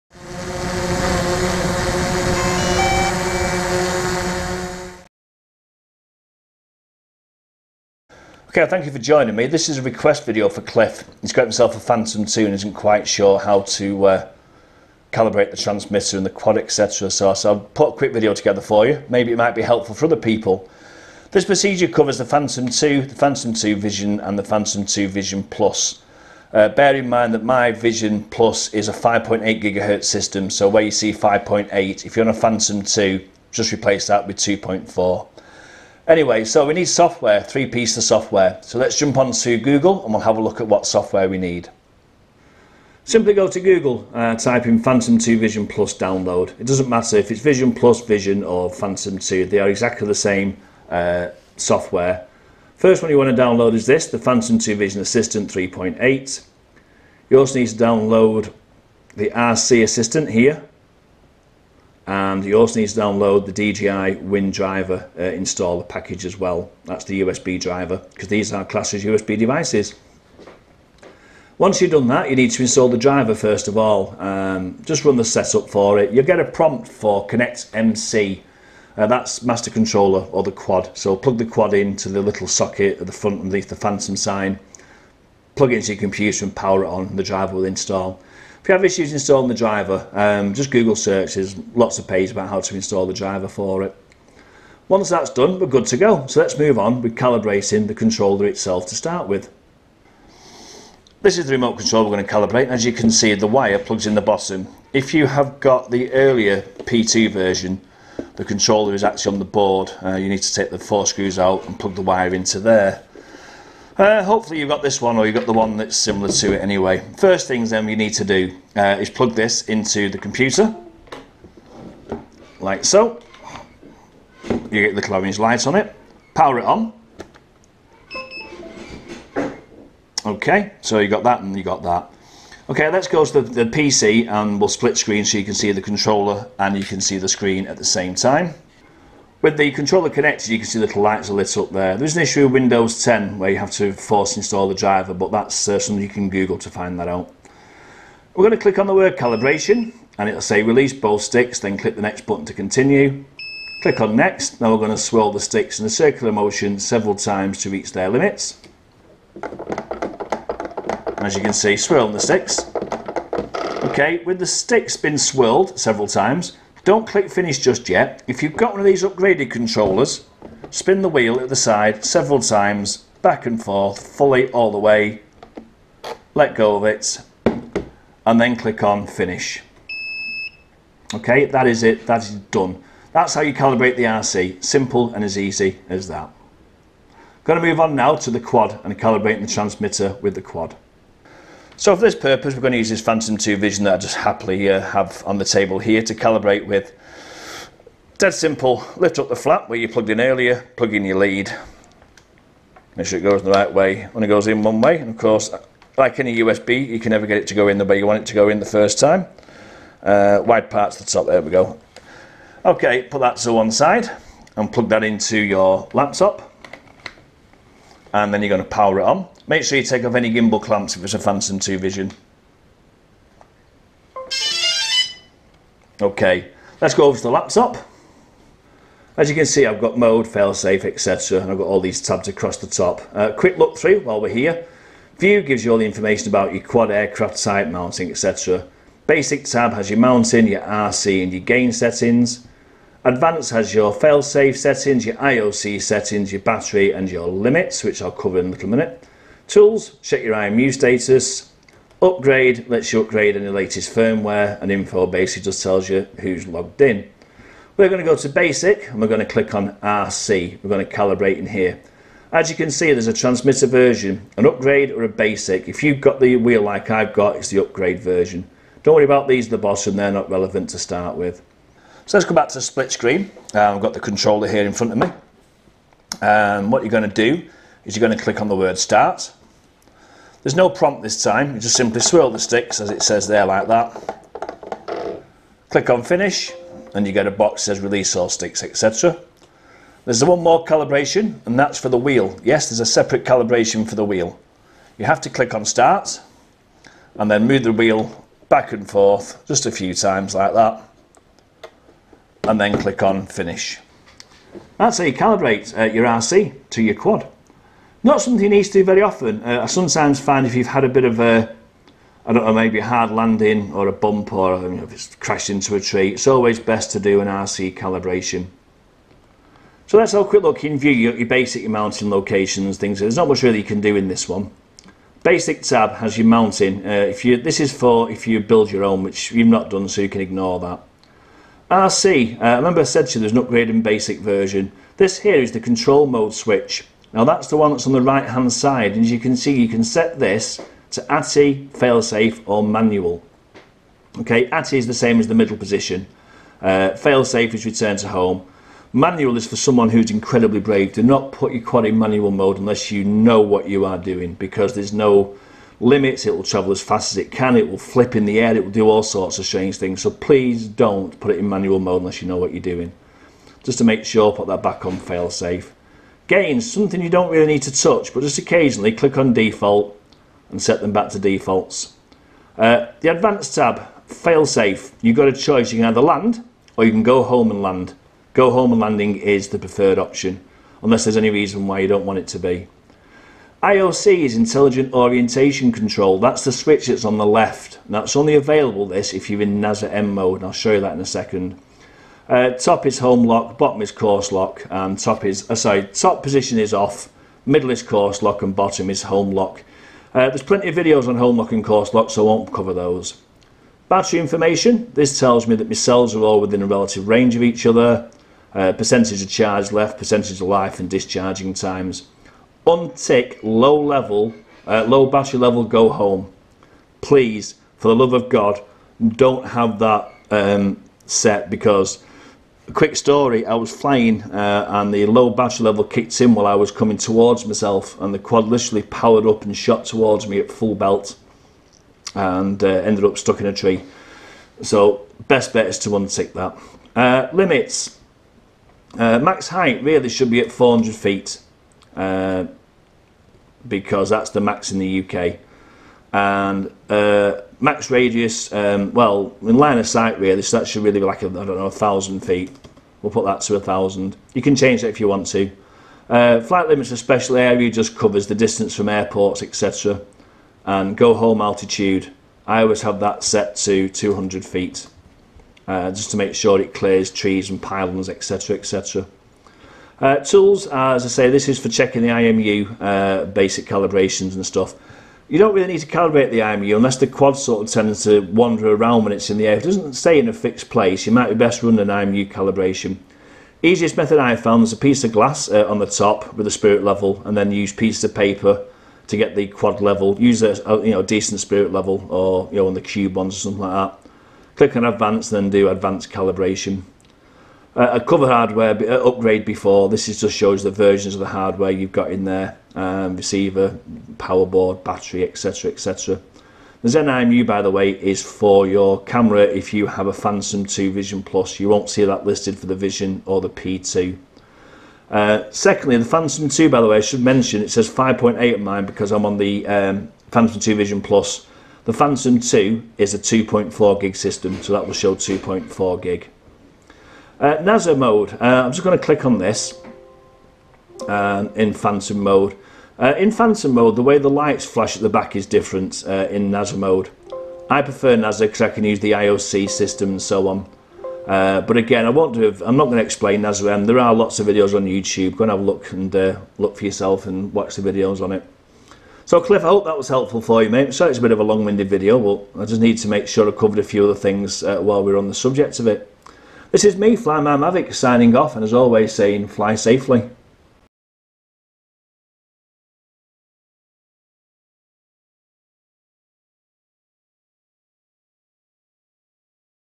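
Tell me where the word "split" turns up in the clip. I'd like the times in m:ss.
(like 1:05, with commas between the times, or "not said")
2:14, 4:32.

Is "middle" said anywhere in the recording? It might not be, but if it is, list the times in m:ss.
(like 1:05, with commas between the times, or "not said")
5:45, 6:37.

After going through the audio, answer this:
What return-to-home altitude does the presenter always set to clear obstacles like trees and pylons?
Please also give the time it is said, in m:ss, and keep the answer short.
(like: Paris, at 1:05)
200 feet, at 7:43.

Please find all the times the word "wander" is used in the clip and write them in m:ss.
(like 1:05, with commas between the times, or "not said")
7:58.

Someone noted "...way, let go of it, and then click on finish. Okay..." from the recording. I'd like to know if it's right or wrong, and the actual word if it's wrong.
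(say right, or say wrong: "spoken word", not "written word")
right.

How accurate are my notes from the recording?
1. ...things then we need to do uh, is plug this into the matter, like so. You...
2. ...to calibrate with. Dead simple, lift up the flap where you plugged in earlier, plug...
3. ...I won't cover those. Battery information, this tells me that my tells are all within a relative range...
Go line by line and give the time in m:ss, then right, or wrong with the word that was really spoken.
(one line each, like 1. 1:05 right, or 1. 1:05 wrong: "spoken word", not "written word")
1. 1:57 wrong: "computer", not "matter"
2. 3:16 right
3. 6:42 wrong: "cells", not "tells".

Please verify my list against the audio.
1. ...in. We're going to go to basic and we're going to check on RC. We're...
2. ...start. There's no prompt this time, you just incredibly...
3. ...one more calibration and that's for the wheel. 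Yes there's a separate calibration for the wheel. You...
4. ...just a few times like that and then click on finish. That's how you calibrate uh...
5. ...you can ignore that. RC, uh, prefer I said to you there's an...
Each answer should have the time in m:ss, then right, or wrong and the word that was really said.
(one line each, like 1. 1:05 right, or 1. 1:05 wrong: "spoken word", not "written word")
1. 4:16 wrong: "click", not "check"
2. 4:38 wrong: "simply", not "incredibly"
3. 4:50 right
4. 4:59 right
5. 5:30 wrong: "remember", not "prefer".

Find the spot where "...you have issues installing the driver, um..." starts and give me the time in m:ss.
1:28.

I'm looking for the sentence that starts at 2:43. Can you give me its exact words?
Okay, with the sticks been swirled several times, don't click finish just yet.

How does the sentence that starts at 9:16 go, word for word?
This is me, Flyman Mavic, signing off, and as always, saying fly safely.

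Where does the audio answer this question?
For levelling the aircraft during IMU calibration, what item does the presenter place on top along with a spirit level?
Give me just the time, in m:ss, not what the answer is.
8:04.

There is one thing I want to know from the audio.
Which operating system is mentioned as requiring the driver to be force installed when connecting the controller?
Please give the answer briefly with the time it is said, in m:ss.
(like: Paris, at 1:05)
Windows 10, at 2:22.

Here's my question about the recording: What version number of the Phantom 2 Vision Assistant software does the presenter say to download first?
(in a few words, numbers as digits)
3.8.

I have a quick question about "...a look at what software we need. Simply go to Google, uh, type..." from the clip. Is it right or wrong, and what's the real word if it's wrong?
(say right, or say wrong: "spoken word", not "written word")
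right.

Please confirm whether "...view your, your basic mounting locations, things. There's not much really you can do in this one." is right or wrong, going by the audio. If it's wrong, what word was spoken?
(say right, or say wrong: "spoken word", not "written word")
right.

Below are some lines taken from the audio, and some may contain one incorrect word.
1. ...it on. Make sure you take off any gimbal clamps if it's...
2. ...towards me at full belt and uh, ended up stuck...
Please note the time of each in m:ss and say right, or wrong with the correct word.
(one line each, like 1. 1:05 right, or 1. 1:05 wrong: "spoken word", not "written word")
1. 3:38 right
2. 7:09 right.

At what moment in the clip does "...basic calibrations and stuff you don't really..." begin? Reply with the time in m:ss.
7:53.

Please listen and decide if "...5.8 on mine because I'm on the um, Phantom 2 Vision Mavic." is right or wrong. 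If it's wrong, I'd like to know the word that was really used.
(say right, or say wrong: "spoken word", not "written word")
wrong: "Plus", not "Mavic".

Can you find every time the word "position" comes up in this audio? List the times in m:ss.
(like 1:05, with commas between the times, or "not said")
5:45, 6:36.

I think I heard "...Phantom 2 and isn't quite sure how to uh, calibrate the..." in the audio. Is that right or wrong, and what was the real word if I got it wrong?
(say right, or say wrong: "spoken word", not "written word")
right.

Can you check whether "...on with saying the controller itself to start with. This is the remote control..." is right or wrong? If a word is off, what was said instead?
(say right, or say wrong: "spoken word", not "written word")
wrong: "calibrating", not "saying".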